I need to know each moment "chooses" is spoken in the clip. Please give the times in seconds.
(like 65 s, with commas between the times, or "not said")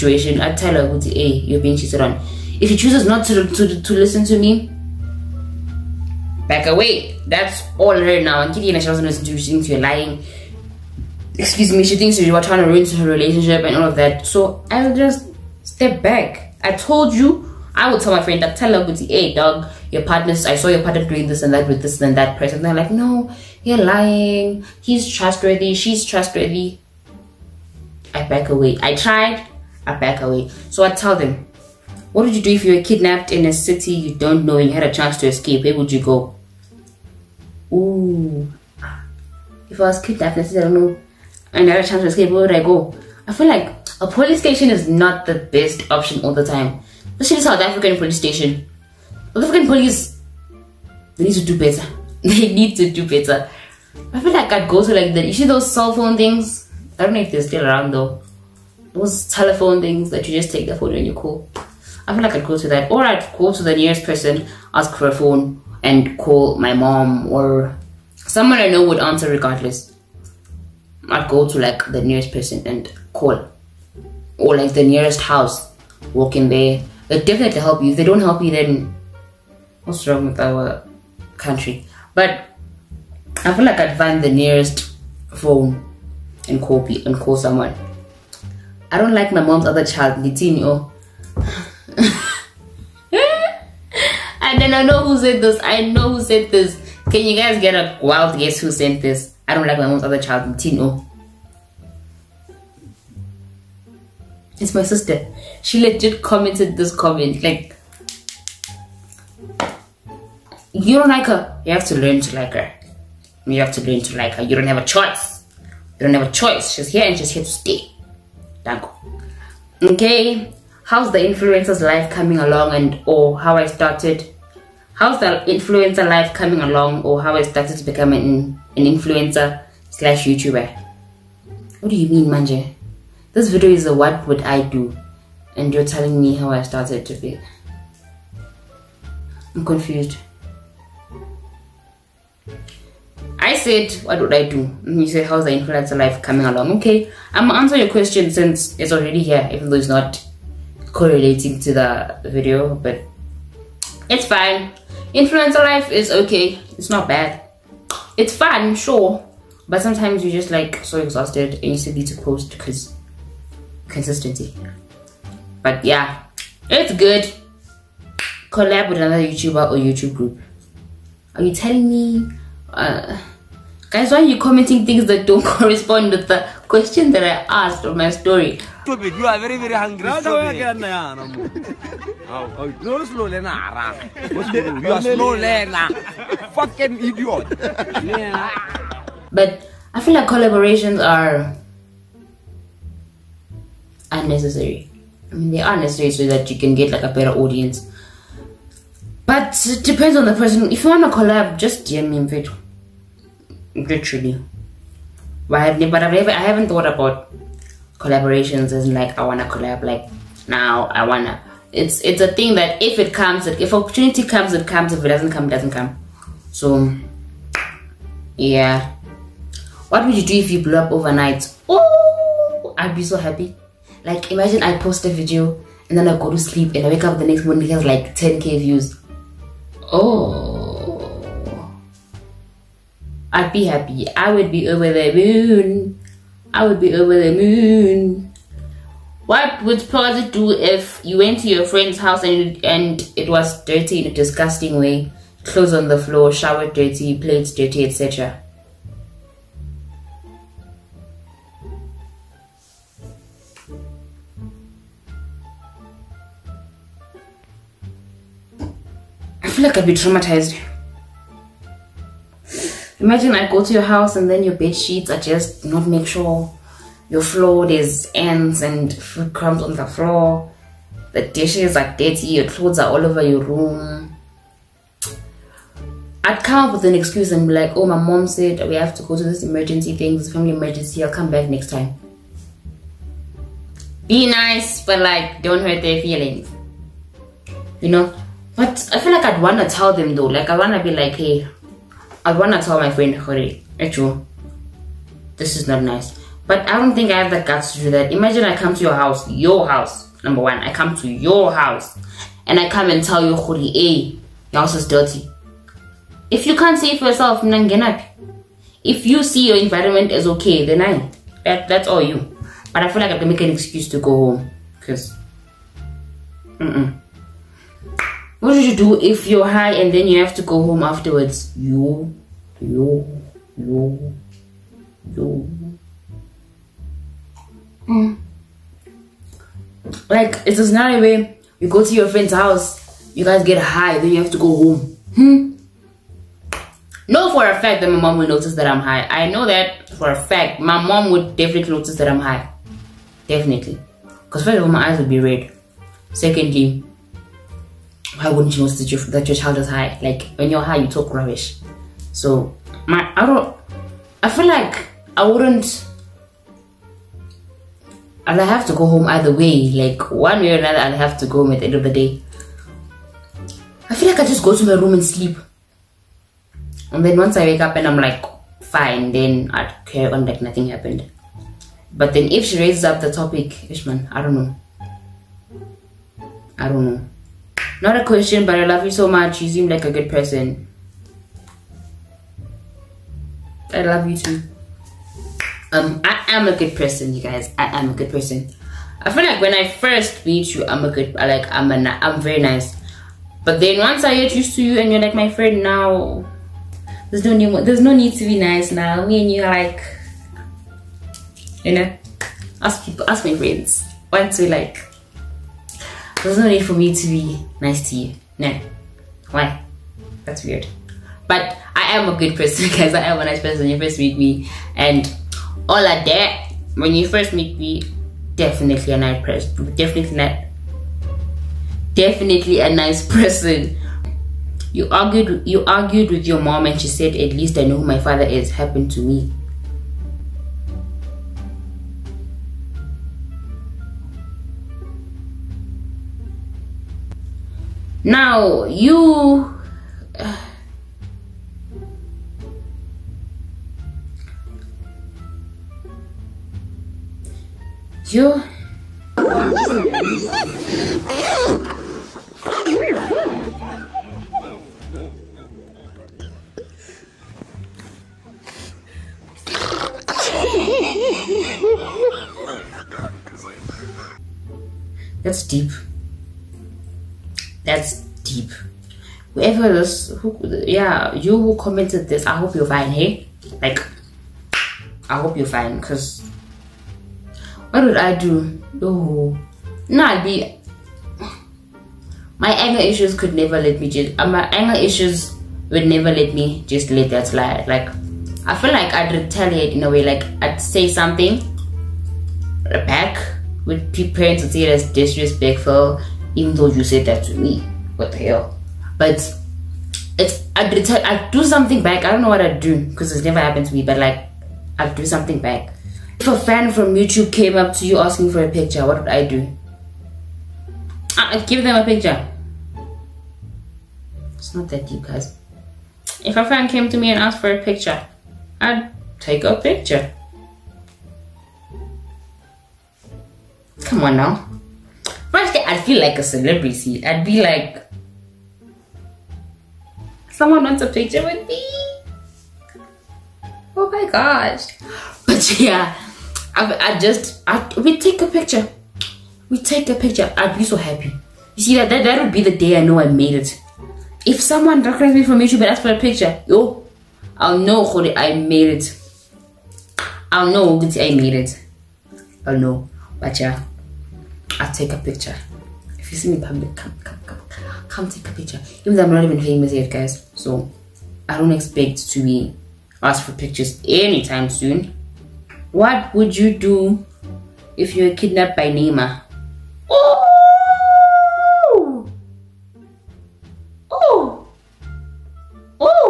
2 s.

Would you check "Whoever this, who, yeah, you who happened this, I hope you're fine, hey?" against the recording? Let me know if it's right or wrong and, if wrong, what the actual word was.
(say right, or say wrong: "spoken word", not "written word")
wrong: "commented", not "happened".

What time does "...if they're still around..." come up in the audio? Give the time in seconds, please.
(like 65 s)
57 s.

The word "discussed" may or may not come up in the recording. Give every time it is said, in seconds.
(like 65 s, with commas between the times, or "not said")
not said.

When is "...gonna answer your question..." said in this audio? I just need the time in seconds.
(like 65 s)
147 s.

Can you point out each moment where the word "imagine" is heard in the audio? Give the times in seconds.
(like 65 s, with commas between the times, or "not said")
224 s, 263 s, 298 s.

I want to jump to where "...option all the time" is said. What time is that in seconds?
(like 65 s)
45 s.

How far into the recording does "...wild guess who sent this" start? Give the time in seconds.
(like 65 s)
98 s.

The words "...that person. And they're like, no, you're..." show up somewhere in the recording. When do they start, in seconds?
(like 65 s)
22 s.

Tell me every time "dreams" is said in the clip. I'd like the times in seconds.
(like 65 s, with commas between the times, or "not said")
not said.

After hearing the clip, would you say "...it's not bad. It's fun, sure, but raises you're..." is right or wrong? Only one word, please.
wrong.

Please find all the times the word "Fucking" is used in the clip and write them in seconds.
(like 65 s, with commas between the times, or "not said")
186 s.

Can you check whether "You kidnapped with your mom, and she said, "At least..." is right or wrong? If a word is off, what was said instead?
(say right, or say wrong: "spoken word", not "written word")
wrong: "argued", not "kidnapped".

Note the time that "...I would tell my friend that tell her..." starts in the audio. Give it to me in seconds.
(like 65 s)
17 s.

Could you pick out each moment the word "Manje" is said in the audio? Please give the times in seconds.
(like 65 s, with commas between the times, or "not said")
132 s.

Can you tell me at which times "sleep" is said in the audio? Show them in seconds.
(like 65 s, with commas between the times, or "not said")
226 s, 365 s.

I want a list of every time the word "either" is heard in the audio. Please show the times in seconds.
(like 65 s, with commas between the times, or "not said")
359 s.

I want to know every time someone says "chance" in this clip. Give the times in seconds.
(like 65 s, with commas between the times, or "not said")
34 s, 41 s.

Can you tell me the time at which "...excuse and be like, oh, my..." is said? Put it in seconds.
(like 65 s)
276 s.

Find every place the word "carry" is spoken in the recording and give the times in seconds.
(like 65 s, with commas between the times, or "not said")
369 s.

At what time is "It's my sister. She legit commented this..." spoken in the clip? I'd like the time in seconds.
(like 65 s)
104 s.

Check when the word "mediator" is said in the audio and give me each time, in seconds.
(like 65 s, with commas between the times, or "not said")
not said.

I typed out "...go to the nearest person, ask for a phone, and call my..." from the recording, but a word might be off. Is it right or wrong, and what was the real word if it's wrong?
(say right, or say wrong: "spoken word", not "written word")
right.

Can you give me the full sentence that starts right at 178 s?
Stupid, you are very, very hungry.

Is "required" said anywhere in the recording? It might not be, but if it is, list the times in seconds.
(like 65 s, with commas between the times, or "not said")
not said.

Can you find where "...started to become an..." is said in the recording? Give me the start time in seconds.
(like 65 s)
127 s.